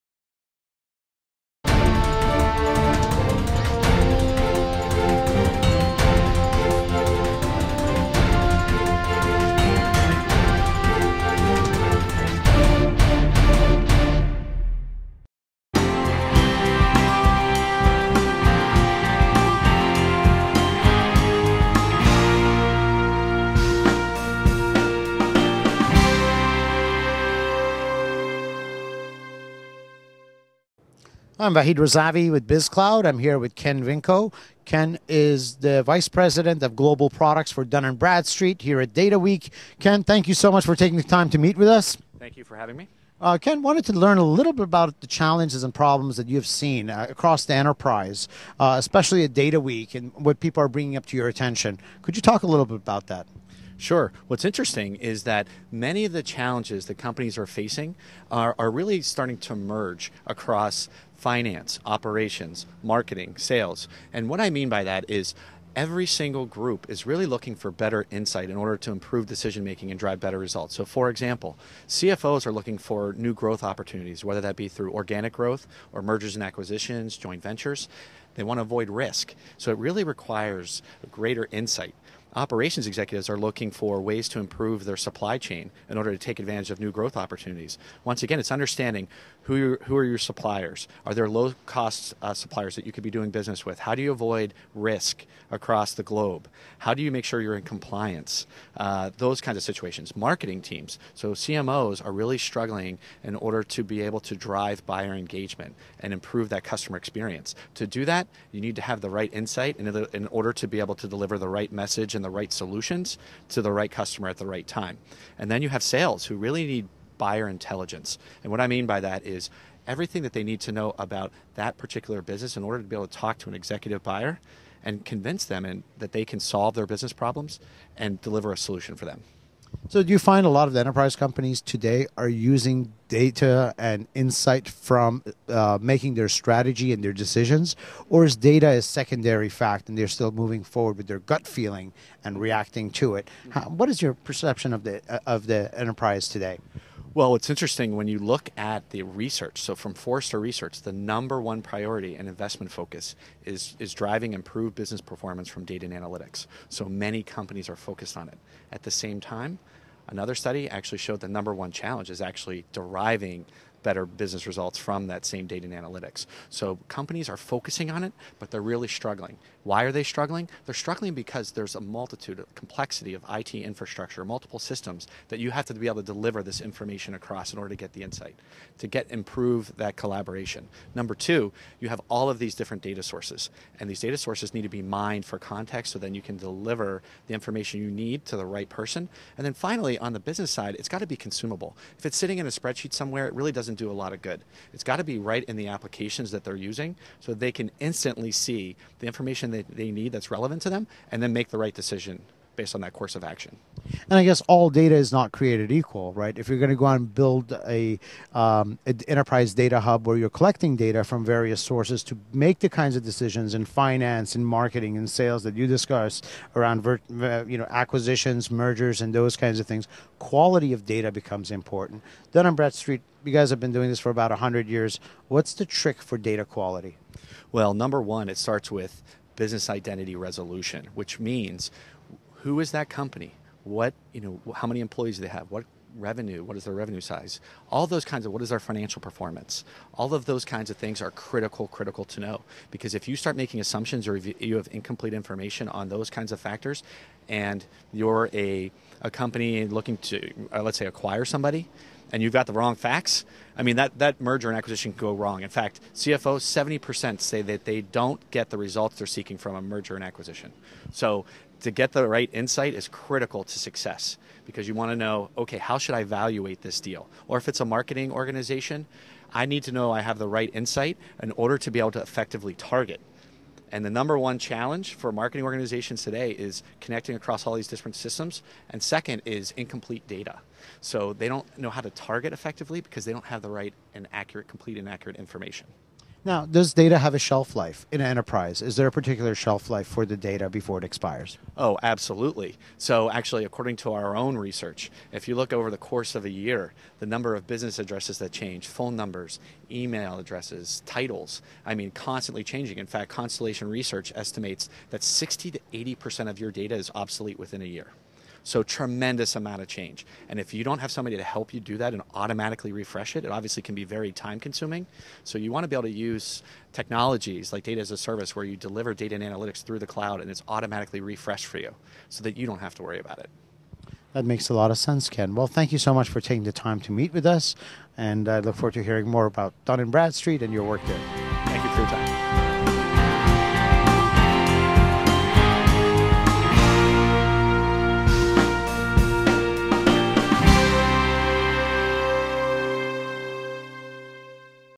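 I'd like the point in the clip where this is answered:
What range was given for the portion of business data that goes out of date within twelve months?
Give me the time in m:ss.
5:05.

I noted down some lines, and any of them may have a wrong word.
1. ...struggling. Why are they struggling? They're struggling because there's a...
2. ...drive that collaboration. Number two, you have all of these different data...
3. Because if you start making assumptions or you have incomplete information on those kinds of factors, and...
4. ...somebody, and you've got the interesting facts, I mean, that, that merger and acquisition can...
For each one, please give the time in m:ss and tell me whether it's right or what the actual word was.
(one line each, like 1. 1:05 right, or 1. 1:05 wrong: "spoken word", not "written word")
1. 2:48 right
2. 2:59 wrong: "improve", not "drive"
3. 4:02 right
4. 4:11 wrong: "wrong", not "interesting".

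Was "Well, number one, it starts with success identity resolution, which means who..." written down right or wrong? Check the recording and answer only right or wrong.
wrong.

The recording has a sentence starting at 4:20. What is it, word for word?
So to get the right insight is critical to success because you want to know, okay, how should I evaluate this deal?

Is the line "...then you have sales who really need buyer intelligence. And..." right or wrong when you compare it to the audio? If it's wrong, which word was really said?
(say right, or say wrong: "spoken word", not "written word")
right.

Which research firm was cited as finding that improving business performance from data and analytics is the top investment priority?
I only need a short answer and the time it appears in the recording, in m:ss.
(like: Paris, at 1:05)
Forrester Research, at 2:29.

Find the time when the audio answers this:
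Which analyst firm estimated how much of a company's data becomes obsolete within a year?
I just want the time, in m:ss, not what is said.
5:03.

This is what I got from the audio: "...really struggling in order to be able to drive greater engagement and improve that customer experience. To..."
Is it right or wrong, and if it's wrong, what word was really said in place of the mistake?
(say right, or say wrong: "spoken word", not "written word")
wrong: "buyer", not "greater".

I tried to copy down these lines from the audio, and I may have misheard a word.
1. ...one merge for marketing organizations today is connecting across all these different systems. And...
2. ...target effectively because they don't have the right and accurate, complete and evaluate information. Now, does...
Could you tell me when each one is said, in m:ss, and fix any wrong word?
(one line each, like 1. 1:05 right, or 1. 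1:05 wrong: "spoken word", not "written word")
1. 4:34 wrong: "challenge", not "merge"
2. 4:41 wrong: "accurate", not "evaluate".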